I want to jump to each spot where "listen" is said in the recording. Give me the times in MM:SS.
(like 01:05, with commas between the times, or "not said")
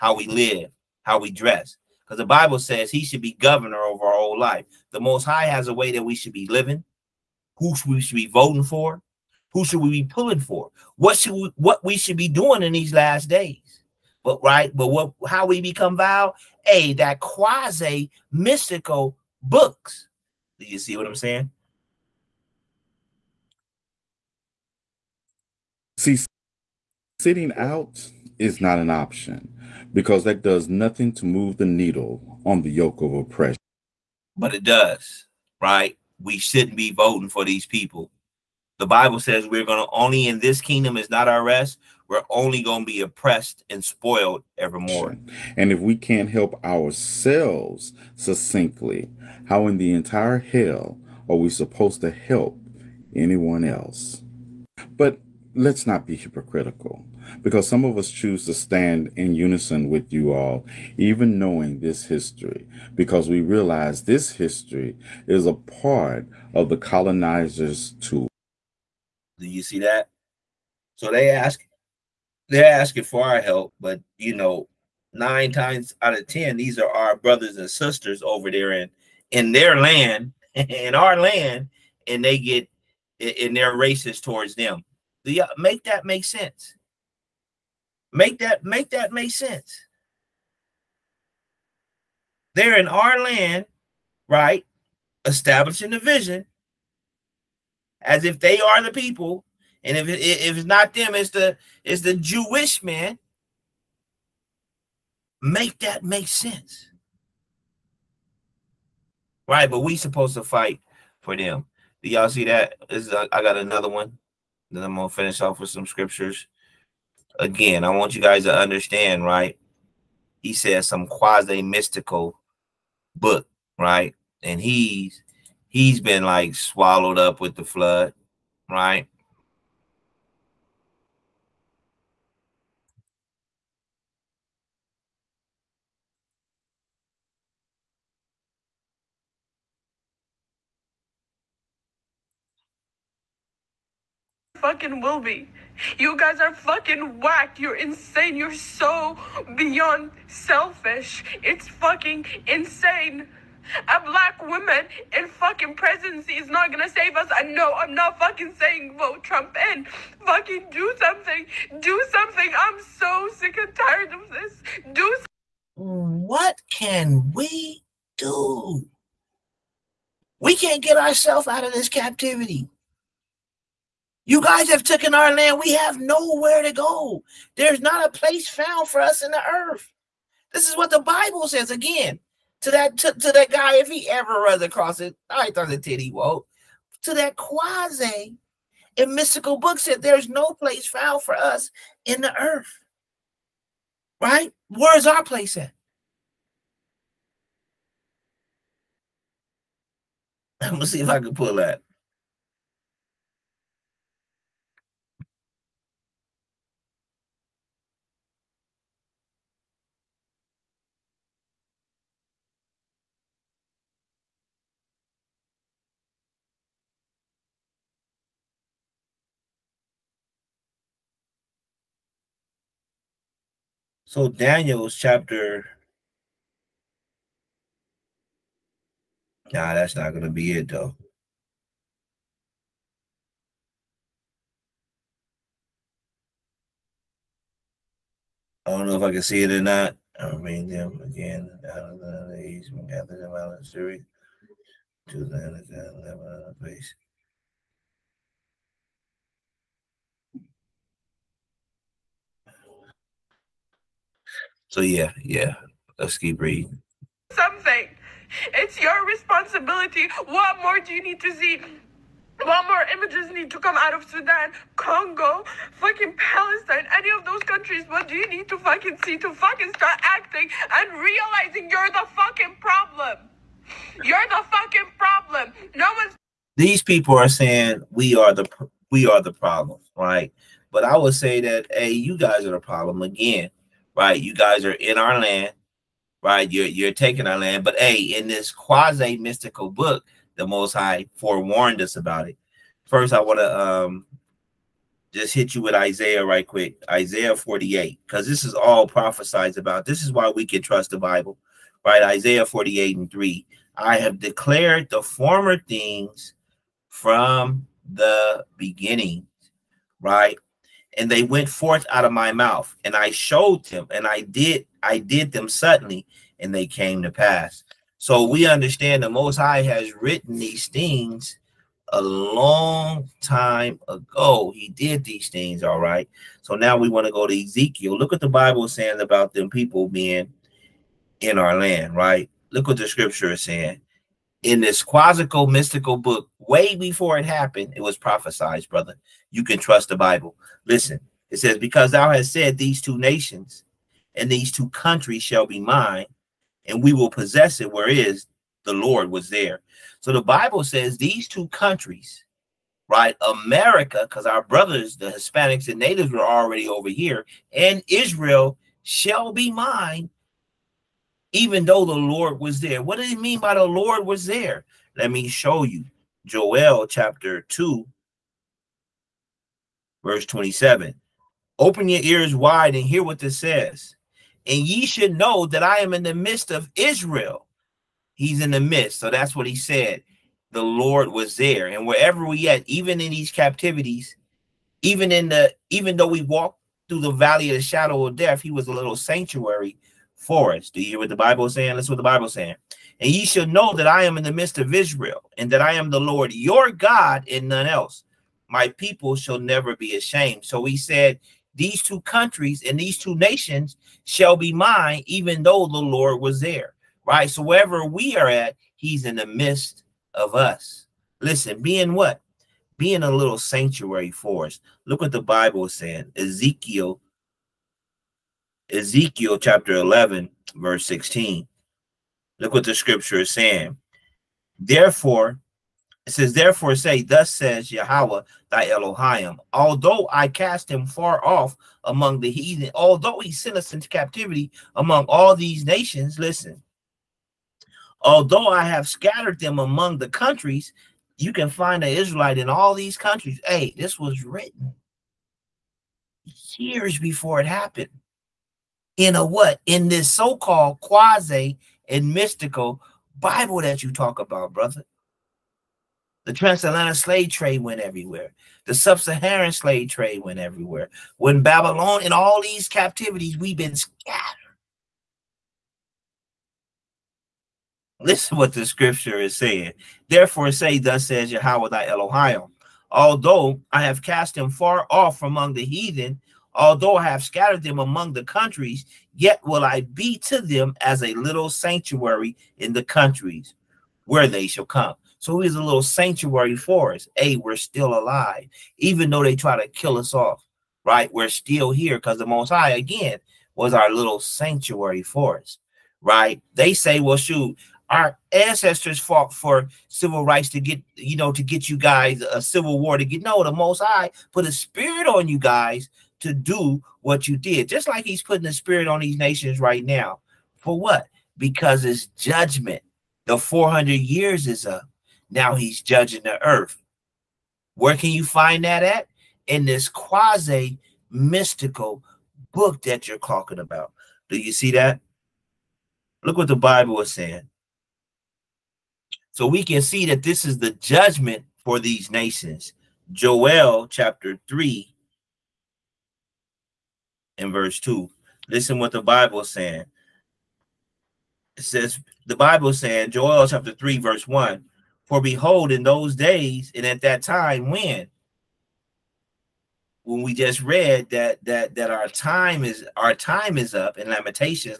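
05:40, 06:51, 07:16, 07:48, 08:58.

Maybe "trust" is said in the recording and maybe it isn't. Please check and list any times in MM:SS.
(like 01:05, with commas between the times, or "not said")
05:00, 05:39.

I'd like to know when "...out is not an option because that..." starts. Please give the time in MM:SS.
00:27.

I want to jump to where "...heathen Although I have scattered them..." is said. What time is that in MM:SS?
07:55.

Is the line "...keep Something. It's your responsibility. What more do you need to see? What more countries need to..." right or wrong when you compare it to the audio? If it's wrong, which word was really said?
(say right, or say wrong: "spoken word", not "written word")
wrong: "images", not "countries".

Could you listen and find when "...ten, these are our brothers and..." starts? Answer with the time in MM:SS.
01:16.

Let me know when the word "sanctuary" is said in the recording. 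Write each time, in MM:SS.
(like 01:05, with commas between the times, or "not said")
06:28, 06:53, 08:01, 08:05, 08:14.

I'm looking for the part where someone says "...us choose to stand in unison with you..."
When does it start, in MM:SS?
00:57.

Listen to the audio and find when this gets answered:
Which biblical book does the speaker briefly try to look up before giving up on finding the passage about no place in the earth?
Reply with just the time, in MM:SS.
03:44.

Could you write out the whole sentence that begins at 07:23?
Hey, this was written years before it happened in a what?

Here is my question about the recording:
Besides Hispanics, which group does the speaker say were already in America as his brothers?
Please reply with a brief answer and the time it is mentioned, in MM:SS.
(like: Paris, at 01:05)
Natives, at 05:55.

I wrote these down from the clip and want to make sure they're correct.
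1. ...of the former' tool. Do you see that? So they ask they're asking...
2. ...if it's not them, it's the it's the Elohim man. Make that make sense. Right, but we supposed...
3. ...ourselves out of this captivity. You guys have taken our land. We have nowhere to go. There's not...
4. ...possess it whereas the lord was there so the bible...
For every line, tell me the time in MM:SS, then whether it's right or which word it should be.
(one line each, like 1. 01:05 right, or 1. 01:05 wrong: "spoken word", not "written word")
1. 01:06 wrong: "colonizers", not "former"
2. 01:40 wrong: "Jewish", not "Elohim"
3. 02:50 right
4. 05:47 right.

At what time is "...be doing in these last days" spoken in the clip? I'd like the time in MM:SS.
00:12.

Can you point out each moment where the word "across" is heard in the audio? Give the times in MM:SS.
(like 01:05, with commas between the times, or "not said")
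03:04.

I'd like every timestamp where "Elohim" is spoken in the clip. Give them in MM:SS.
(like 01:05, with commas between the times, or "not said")
07:08, 07:51.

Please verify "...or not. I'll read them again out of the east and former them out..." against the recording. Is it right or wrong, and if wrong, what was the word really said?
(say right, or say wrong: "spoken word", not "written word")
wrong: "gather", not "former".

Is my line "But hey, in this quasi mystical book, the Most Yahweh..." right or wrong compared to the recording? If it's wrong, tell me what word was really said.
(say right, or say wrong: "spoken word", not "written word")
wrong: "High", not "Yahweh".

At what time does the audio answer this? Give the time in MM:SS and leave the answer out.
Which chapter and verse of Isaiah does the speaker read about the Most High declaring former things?
05:02.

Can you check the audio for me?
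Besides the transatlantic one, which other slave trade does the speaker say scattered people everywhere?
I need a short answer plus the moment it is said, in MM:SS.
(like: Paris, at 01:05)
Sub-Saharan, at 07:38.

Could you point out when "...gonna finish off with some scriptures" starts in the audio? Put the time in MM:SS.
01:54.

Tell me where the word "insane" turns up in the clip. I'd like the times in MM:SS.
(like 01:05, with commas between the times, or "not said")
02:27, 02:32.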